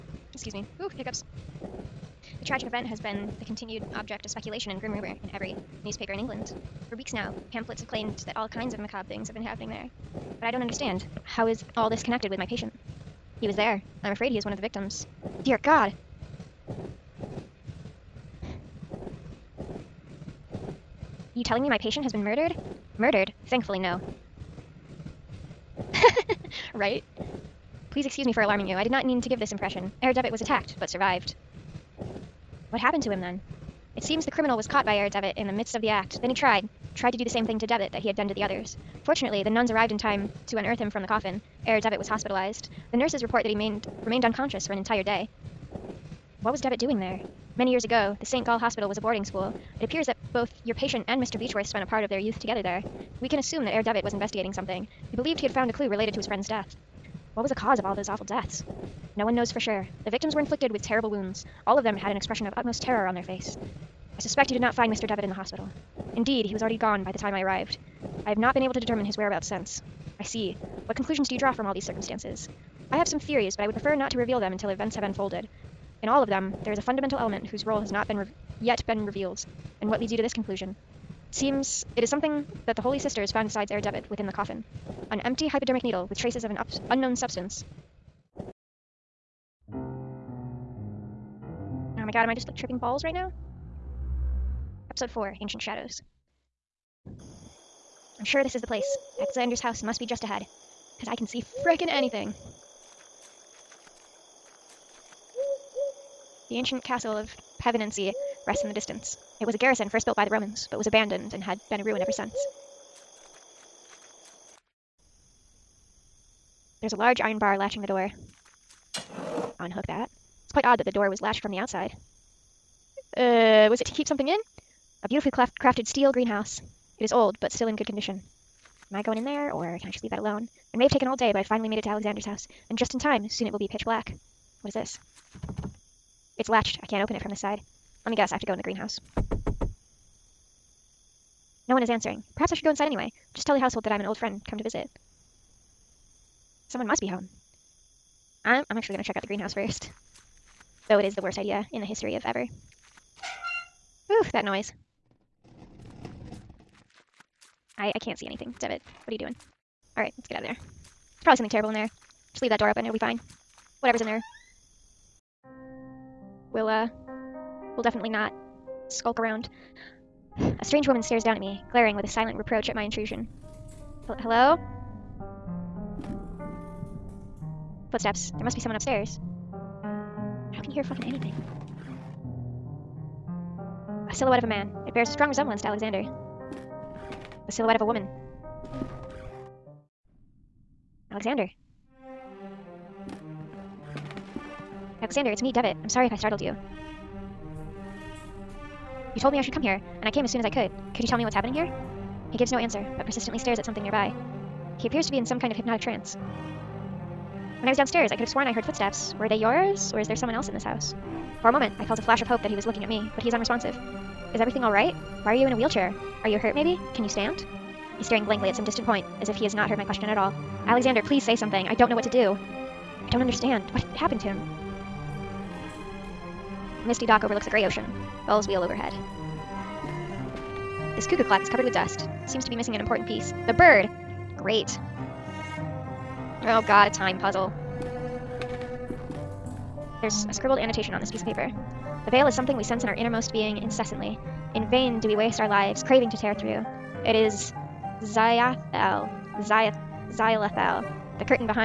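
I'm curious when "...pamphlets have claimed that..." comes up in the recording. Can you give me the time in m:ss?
0:07.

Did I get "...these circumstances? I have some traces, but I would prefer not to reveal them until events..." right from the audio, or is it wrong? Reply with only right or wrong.
wrong.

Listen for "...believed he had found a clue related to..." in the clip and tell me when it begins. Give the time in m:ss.
0:55.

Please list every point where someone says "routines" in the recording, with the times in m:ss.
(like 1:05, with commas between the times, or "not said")
not said.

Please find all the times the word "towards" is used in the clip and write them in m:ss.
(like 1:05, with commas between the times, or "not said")
not said.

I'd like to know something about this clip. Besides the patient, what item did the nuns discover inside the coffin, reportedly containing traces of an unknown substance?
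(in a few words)
hypodermic needle.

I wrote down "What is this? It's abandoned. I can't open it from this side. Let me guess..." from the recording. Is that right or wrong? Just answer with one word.
wrong.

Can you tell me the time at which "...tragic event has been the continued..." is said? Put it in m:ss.
0:02.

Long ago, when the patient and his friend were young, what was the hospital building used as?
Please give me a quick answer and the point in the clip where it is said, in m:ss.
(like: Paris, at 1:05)
boarding school, at 0:49.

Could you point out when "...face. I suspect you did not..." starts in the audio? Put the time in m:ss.
1:03.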